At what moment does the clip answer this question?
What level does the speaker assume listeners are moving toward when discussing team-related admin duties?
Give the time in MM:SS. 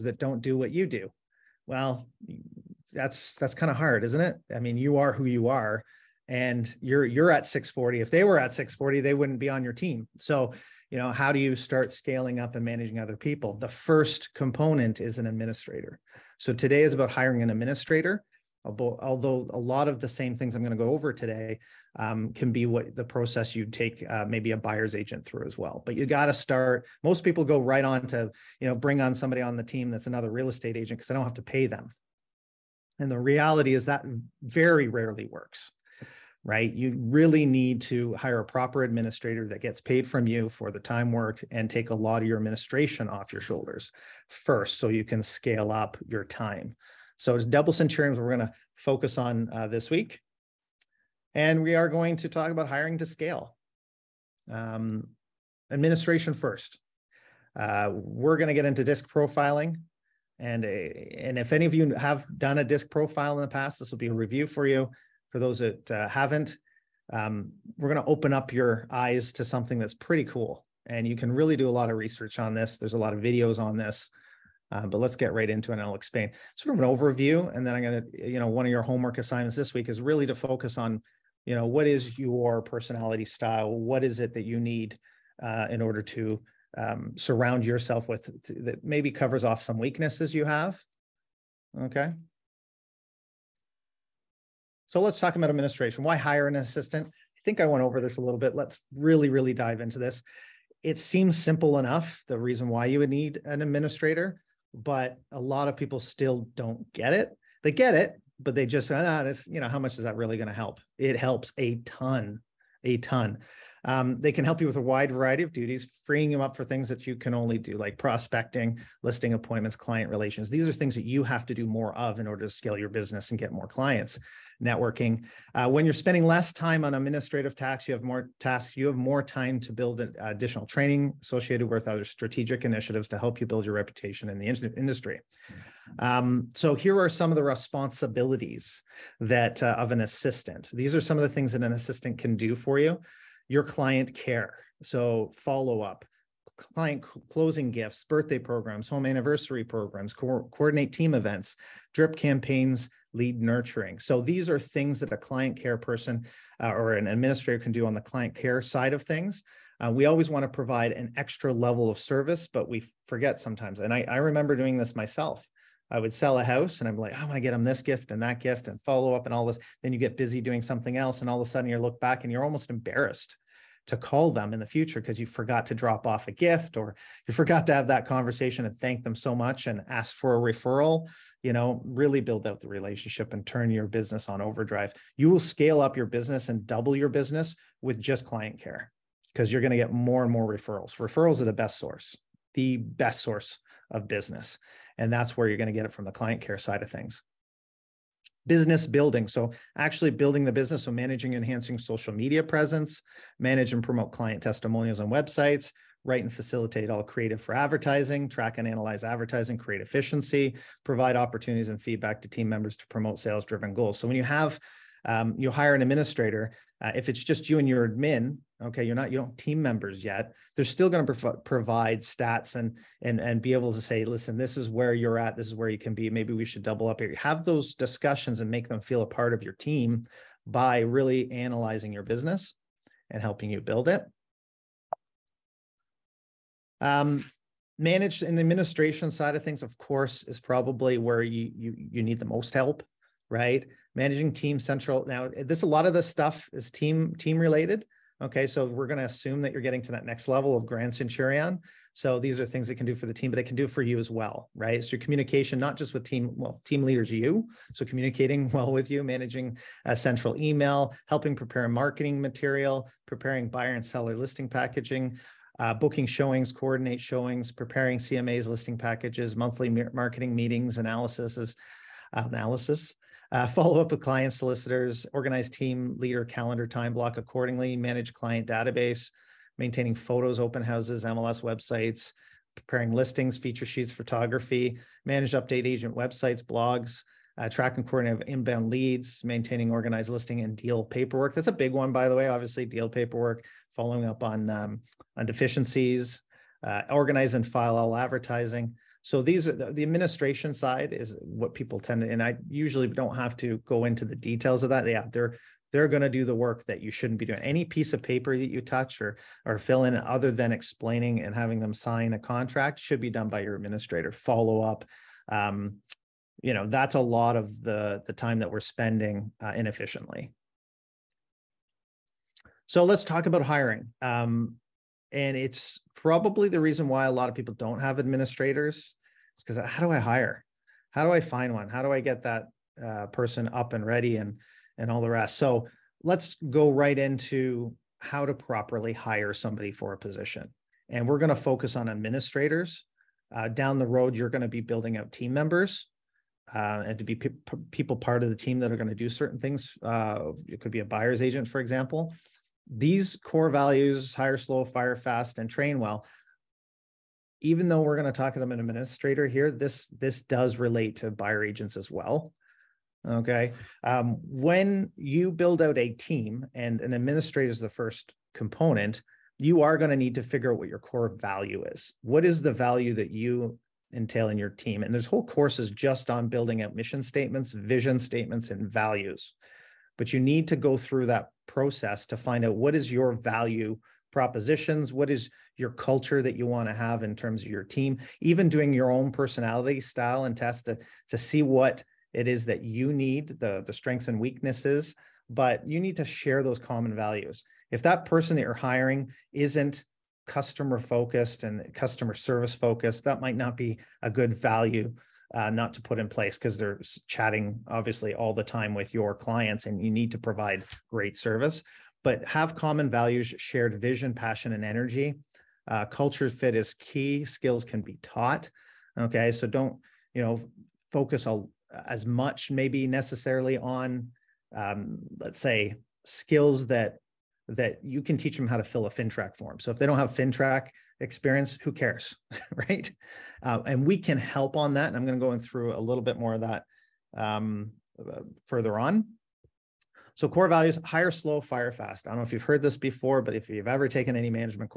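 04:10.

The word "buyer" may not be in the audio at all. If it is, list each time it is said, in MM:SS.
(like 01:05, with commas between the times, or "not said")
00:24, 04:23, 05:50, 06:01.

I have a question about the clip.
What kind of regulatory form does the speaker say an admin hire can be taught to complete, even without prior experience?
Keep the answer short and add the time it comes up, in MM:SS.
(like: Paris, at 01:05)
FINTRAC form, at 07:08.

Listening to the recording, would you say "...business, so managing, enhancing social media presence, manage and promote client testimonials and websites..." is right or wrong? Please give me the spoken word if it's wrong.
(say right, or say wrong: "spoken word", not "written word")
right.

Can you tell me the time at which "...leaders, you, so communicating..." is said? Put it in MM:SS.
04:16.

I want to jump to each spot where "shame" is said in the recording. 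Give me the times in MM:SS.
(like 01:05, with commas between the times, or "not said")
not said.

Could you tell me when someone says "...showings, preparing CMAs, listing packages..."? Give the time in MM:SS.
04:27.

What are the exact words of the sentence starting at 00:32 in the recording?
And the reality is that very rarely works, right?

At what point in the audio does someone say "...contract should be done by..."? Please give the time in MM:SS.
05:12.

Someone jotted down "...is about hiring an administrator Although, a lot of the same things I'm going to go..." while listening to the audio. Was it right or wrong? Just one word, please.
right.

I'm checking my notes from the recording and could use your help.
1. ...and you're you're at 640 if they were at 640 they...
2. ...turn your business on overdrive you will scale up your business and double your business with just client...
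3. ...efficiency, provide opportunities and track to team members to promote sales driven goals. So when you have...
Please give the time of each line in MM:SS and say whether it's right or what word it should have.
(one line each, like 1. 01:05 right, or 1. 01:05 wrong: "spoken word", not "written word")
1. 00:06 right
2. 03:03 right
3. 03:29 wrong: "feedback", not "track".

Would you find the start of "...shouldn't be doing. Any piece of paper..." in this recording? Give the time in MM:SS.
05:06.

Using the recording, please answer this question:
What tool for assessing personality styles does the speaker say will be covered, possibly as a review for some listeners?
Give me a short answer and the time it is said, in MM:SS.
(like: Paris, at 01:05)
DISC profiling, at 00:58.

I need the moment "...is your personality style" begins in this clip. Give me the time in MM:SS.
01:21.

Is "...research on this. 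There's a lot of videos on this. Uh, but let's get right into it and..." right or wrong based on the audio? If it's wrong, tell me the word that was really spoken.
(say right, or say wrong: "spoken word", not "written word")
right.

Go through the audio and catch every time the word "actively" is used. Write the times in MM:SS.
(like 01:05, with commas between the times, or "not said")
not said.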